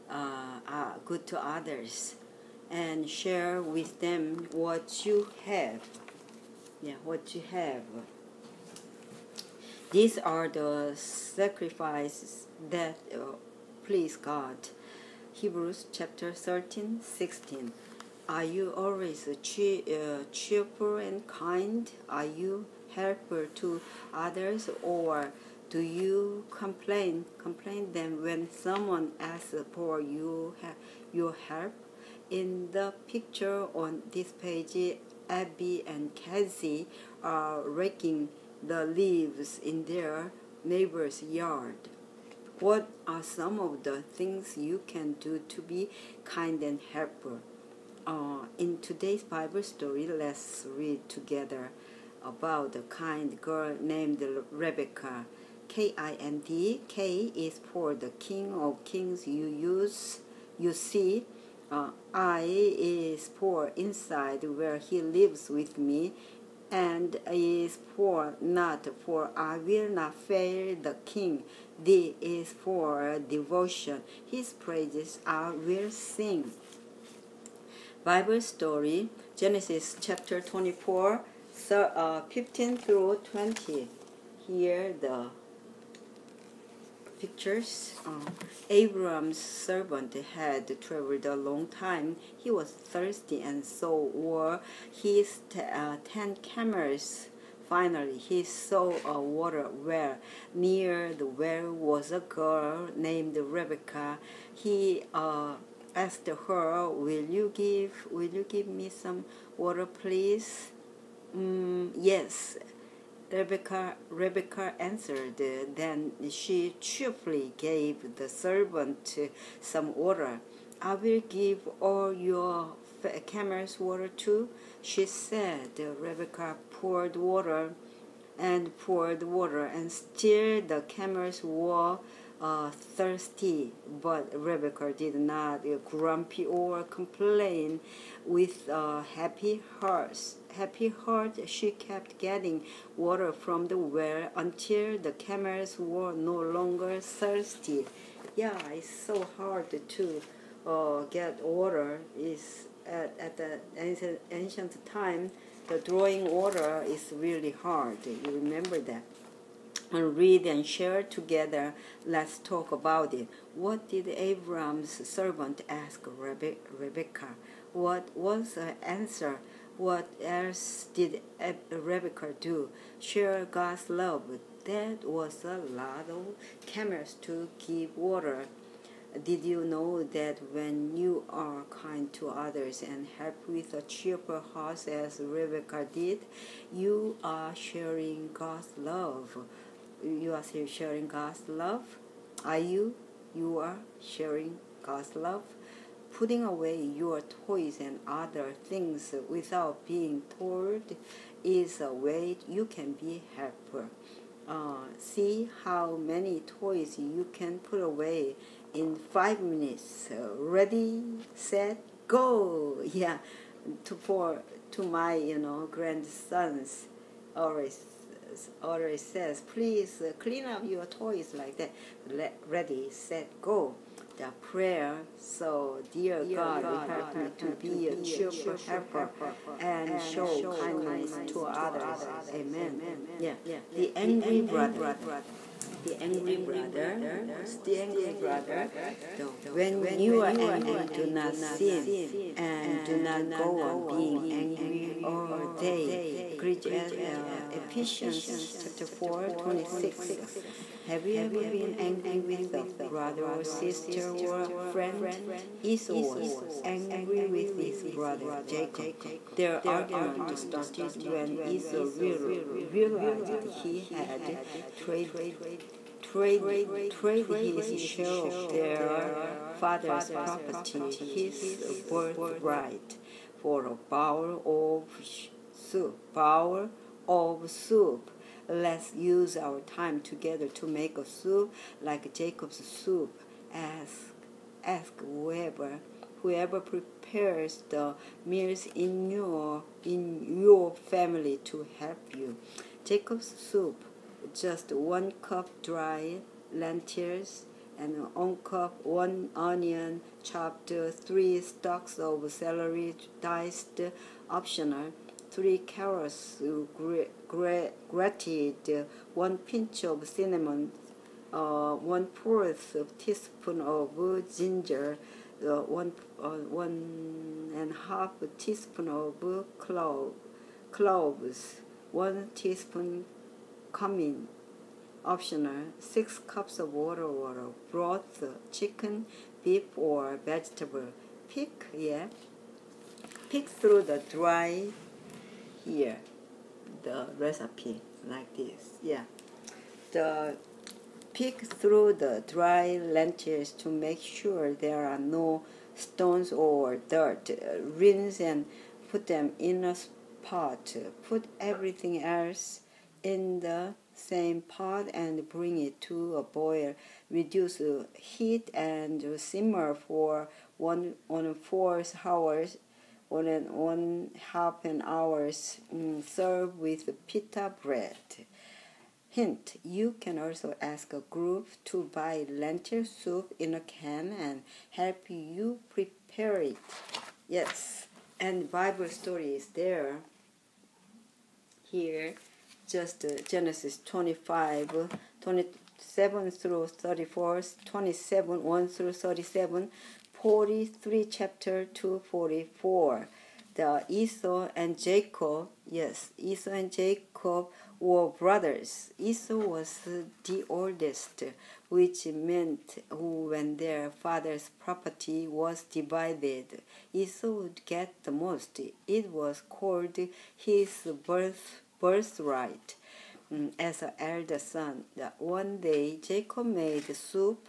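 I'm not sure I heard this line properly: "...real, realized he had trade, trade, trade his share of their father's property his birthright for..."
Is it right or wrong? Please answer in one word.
right.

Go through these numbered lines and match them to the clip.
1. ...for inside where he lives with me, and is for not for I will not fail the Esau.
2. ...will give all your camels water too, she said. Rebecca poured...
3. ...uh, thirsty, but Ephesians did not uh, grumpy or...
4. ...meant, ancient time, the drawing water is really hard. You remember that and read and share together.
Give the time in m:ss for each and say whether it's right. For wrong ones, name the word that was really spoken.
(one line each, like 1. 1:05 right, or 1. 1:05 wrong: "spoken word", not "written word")
1. 1:03 wrong: "King", not "Esau"
2. 2:00 right
3. 2:12 wrong: "Rebecca", not "Ephesians"
4. 2:33 wrong: "ancient", not "meant".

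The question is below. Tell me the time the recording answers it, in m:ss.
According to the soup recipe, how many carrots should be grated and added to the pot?
5:05.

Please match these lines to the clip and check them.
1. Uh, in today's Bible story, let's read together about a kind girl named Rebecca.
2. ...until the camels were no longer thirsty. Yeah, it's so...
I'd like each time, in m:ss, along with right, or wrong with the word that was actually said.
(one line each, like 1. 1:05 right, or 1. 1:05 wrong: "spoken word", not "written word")
1. 0:48 right
2. 2:24 right.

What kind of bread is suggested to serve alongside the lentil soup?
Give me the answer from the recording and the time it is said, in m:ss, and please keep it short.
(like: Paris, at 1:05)
pita bread, at 6:07.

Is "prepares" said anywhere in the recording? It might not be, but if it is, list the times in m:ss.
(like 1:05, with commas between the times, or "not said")
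4:46, 6:15.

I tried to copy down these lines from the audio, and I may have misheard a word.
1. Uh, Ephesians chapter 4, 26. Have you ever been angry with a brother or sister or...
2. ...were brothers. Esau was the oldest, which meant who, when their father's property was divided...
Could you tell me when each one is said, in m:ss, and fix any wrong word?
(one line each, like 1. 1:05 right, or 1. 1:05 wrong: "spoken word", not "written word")
1. 4:06 right
2. 6:37 right.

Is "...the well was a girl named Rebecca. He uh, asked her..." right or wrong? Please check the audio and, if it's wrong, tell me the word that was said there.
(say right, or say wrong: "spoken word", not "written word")
right.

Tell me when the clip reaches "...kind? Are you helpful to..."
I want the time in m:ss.
0:21.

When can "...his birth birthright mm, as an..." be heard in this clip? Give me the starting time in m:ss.
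6:50.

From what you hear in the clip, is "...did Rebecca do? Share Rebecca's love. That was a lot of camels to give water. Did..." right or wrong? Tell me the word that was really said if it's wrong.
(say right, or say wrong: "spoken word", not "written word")
wrong: "God", not "Rebecca".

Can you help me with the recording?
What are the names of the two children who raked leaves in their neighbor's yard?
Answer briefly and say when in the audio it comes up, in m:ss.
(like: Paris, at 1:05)
Abby and Cassie, at 0:35.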